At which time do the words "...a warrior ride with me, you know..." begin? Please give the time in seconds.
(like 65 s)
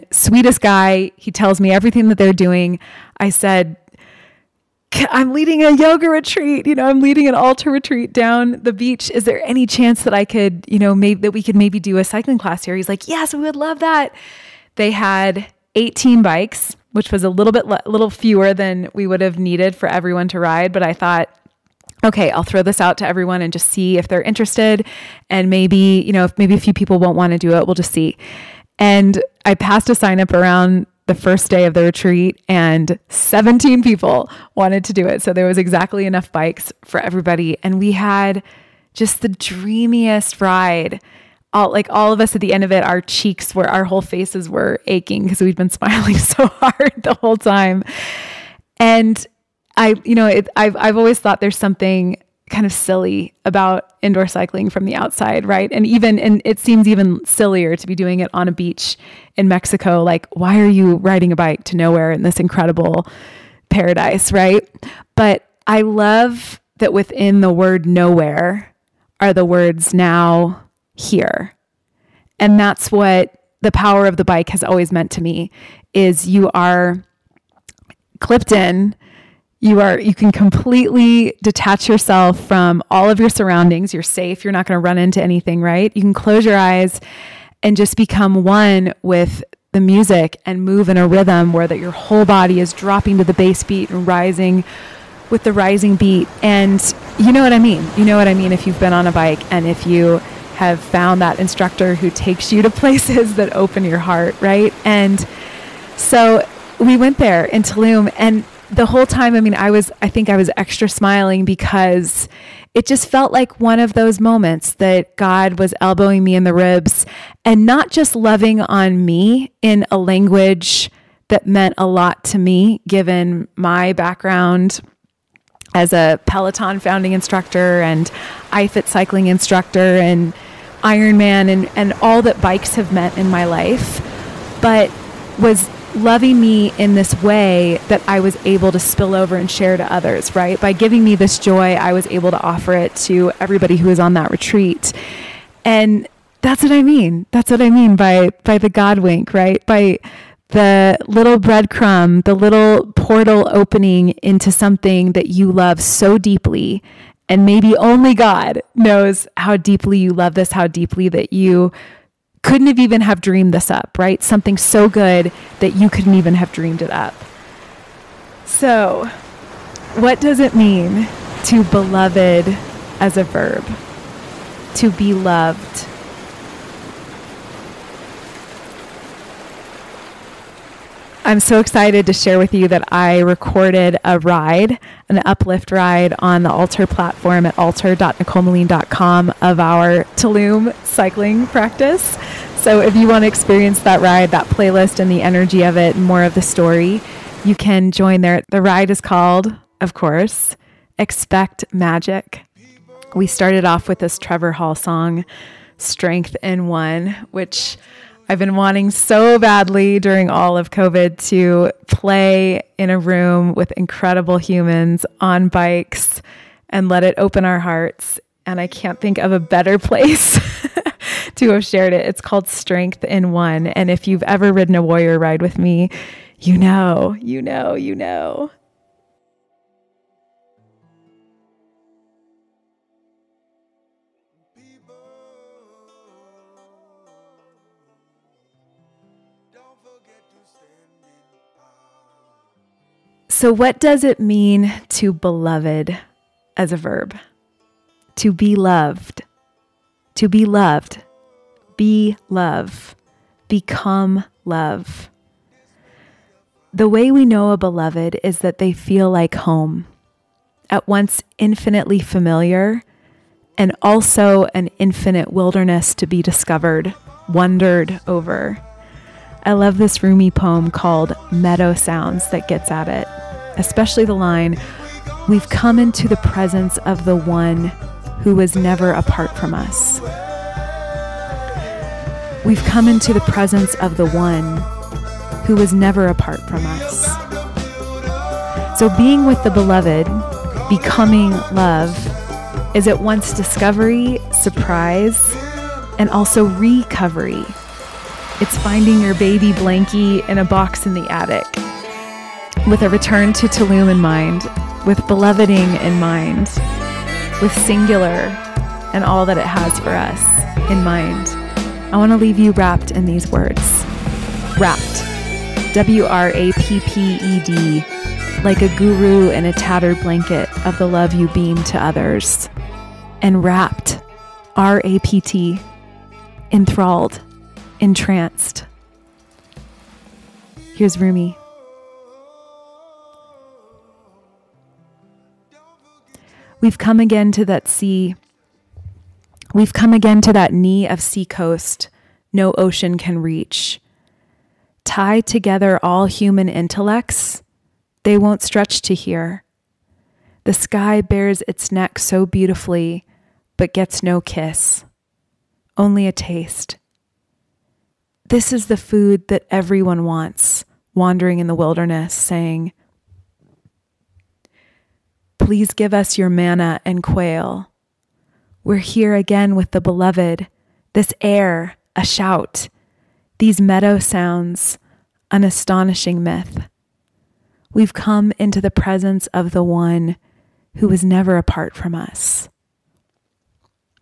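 224 s.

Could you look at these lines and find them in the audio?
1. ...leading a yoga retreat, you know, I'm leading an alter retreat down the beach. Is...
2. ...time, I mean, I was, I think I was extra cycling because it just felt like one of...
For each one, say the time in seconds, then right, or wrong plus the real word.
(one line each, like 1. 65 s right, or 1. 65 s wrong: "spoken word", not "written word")
1. 5 s right
2. 109 s wrong: "smiling", not "cycling".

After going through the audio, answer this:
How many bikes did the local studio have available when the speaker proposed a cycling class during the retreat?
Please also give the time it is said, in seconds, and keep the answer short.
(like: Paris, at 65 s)
18, at 15 s.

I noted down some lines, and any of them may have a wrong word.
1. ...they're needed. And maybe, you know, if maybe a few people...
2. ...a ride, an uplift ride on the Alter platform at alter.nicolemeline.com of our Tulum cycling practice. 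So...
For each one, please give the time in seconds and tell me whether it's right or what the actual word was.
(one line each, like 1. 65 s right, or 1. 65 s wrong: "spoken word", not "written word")
1. 24 s wrong: "interested", not "needed"
2. 184 s right.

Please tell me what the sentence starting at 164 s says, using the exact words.
Something so good that you couldn't even have dreamed it up.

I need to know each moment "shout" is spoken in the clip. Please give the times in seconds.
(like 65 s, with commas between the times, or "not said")
372 s.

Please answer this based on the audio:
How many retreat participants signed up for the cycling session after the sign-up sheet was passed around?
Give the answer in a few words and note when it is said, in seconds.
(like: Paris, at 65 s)
17, at 33 s.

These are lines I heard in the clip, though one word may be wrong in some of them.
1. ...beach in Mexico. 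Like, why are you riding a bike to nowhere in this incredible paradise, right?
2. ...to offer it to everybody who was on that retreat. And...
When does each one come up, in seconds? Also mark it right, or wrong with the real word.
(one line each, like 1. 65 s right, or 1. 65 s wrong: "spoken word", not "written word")
1. 58 s right
2. 142 s right.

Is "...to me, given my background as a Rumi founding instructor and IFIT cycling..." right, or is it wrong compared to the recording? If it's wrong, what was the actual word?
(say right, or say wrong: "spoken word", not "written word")
wrong: "Peloton", not "Rumi".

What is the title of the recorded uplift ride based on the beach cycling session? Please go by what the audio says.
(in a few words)
Expect Magic.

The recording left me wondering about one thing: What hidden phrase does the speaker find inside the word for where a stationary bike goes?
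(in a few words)
now here.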